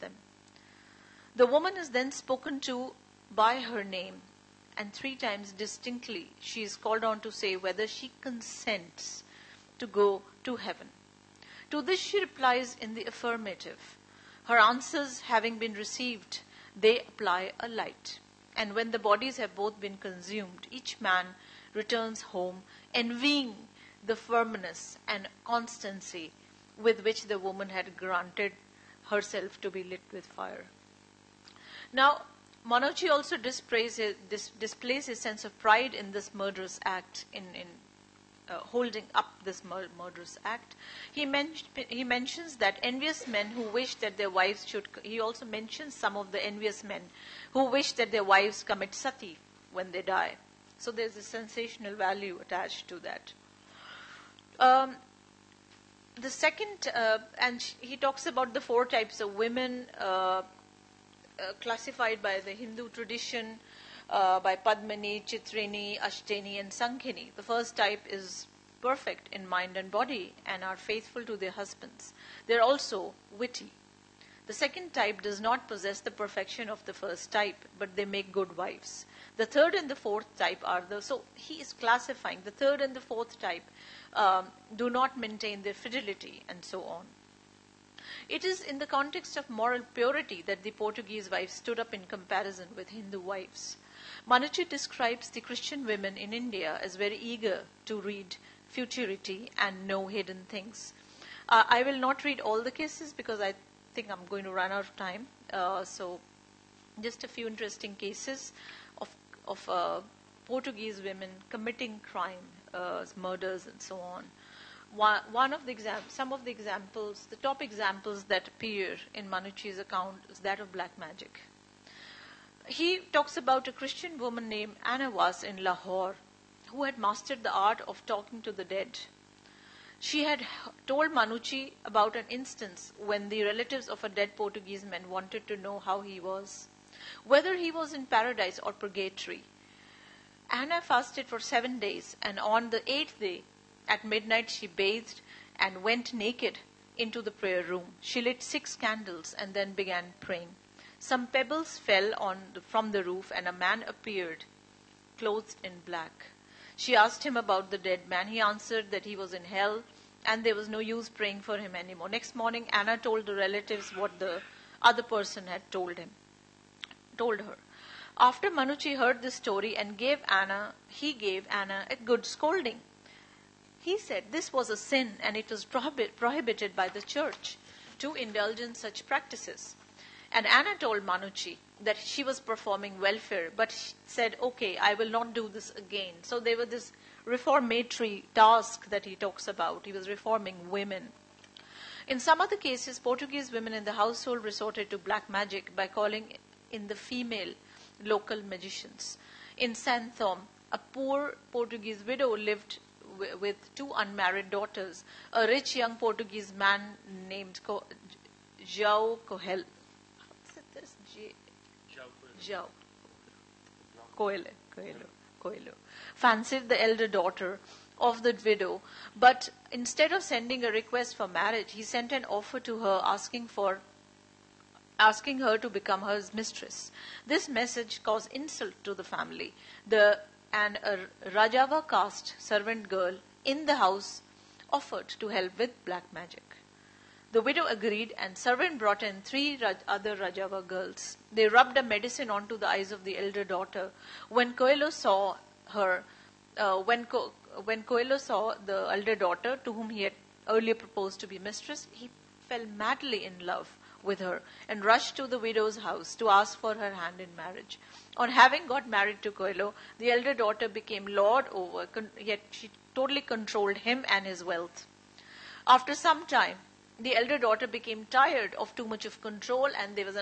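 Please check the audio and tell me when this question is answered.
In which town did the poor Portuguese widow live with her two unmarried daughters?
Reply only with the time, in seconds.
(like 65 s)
199 s.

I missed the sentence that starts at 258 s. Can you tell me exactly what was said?
On having got married to Coelho, the elder daughter became lord over, con- yet she totally controlled him and his wealth.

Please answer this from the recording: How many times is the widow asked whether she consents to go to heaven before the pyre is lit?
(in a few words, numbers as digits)
3.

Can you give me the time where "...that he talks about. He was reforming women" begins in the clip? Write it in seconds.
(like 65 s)
188 s.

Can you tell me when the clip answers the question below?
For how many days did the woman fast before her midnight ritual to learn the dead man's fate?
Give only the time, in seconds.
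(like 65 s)
141 s.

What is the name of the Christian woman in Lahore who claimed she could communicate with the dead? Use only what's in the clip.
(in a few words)
Anna Was.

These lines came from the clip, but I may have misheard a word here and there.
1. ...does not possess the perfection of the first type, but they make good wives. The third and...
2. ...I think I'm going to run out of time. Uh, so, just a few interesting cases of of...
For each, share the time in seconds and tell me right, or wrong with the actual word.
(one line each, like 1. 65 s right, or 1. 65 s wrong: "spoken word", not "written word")
1. 75 s right
2. 103 s right.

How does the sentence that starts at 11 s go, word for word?
To this she replies in the affirmative.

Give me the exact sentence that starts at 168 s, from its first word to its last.
After Manucci heard this story and gave Anna, he gave Anna a good scolding.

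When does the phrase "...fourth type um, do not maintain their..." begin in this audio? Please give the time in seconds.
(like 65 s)
83 s.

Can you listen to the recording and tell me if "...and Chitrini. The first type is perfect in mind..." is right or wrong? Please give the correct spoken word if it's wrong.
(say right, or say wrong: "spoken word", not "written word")
wrong: "Sankhini", not "Chitrini".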